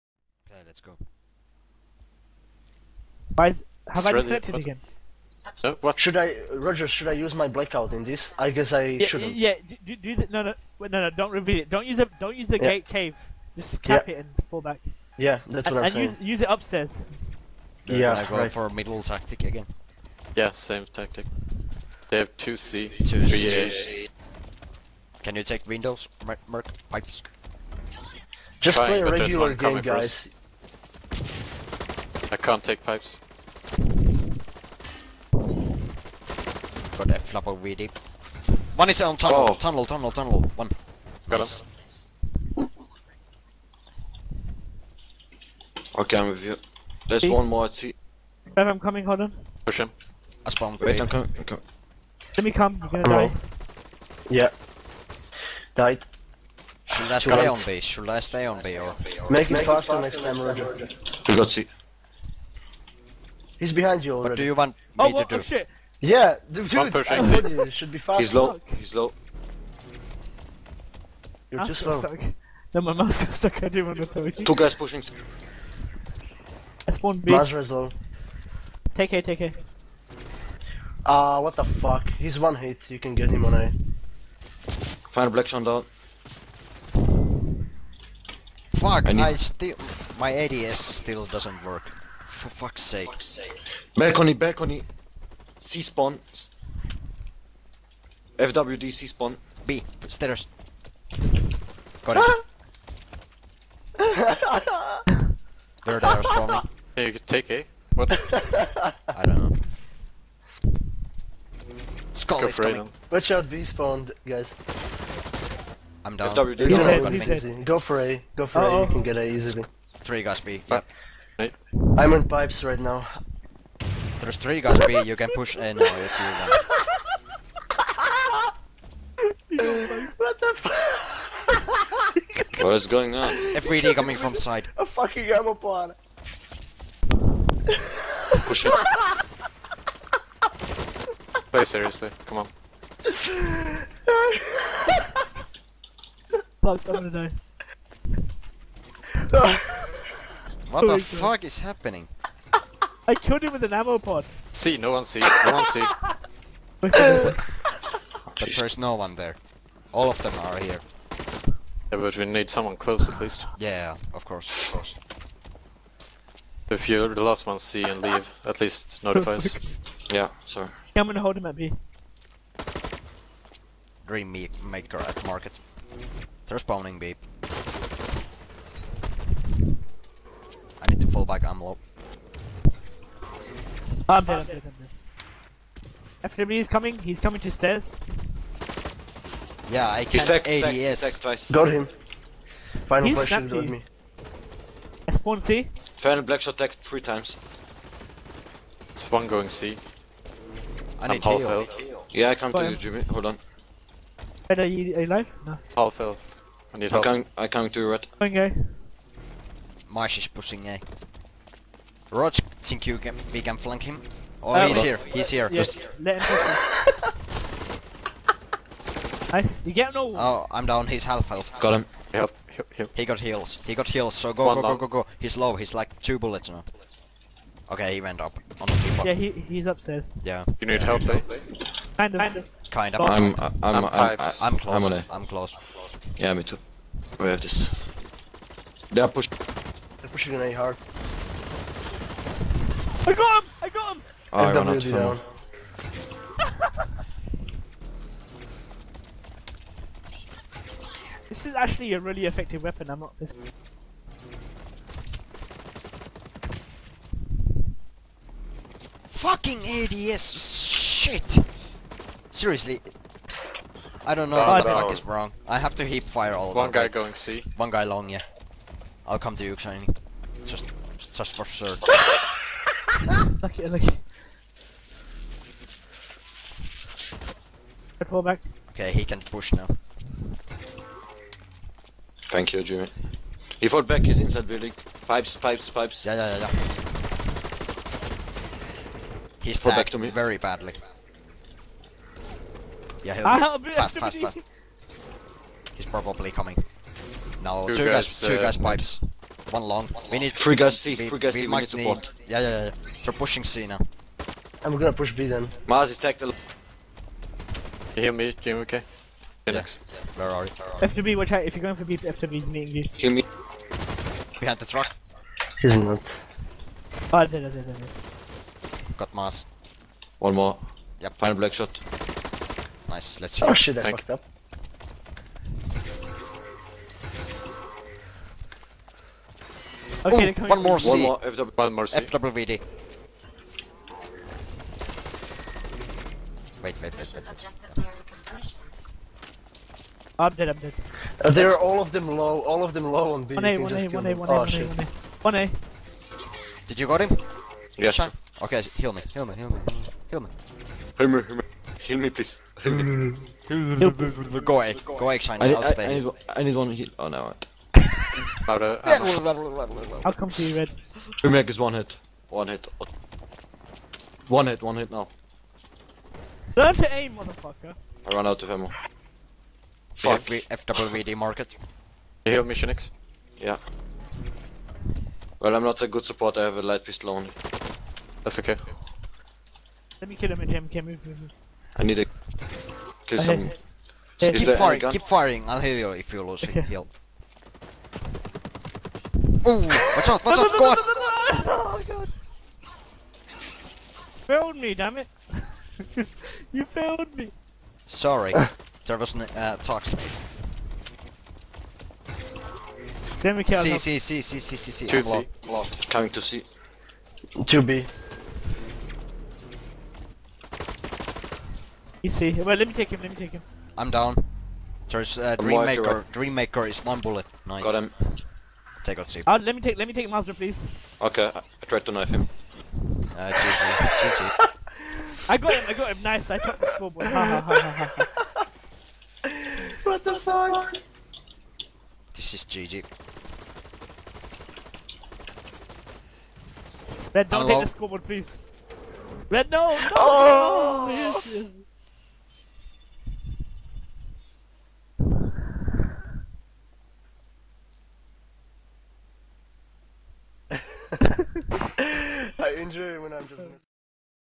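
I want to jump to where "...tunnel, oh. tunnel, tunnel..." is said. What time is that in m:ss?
0:39.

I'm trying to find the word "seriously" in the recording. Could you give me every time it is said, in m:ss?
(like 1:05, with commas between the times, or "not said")
2:21, 4:22.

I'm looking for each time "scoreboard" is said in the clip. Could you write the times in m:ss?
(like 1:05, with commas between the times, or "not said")
7:06, 7:17.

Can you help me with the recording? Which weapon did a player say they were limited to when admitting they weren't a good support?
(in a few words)
Light pistol.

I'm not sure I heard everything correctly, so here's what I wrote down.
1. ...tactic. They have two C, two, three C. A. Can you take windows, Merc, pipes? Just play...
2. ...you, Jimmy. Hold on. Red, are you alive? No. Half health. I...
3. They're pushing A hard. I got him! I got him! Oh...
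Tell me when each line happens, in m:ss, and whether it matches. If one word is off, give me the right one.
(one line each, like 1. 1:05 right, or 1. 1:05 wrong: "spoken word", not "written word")
1. 0:20 right
2. 3:22 right
3. 4:00 right.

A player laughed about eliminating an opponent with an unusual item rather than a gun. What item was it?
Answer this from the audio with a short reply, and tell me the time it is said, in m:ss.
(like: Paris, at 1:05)
An ammo pod, at 2:33.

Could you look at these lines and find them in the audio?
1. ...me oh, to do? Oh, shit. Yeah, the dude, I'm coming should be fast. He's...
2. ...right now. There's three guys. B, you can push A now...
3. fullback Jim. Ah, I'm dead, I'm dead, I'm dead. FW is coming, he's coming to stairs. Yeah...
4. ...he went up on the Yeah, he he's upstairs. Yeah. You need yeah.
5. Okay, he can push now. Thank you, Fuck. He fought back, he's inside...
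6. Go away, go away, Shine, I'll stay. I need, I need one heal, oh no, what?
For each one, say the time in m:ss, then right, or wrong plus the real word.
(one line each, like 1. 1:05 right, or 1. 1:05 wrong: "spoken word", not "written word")
1. 1:05 wrong: "pushing", not "coming"
2. 2:02 right
3. 3:01 wrong: "Amlop", not "Jim"
4. 3:47 right
5. 4:38 wrong: "Jimmy", not "Fuck"
6. 5:53 right.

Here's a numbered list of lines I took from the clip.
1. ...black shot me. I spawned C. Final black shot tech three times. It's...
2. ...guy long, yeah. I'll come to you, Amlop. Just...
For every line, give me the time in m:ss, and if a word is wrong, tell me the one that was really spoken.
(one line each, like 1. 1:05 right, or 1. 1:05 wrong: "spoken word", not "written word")
1. 3:13 right
2. 4:27 wrong: "Shiny", not "Amlop".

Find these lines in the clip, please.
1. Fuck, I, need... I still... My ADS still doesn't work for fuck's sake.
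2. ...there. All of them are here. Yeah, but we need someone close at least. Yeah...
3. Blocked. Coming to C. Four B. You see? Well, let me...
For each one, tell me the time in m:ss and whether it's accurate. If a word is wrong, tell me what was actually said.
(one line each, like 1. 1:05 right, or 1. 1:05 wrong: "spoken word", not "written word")
1. 1:28 right
2. 2:39 right
3. 6:45 wrong: "Two", not "Four".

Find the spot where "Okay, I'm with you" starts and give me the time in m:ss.
0:45.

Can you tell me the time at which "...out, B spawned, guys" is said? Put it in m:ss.
1:53.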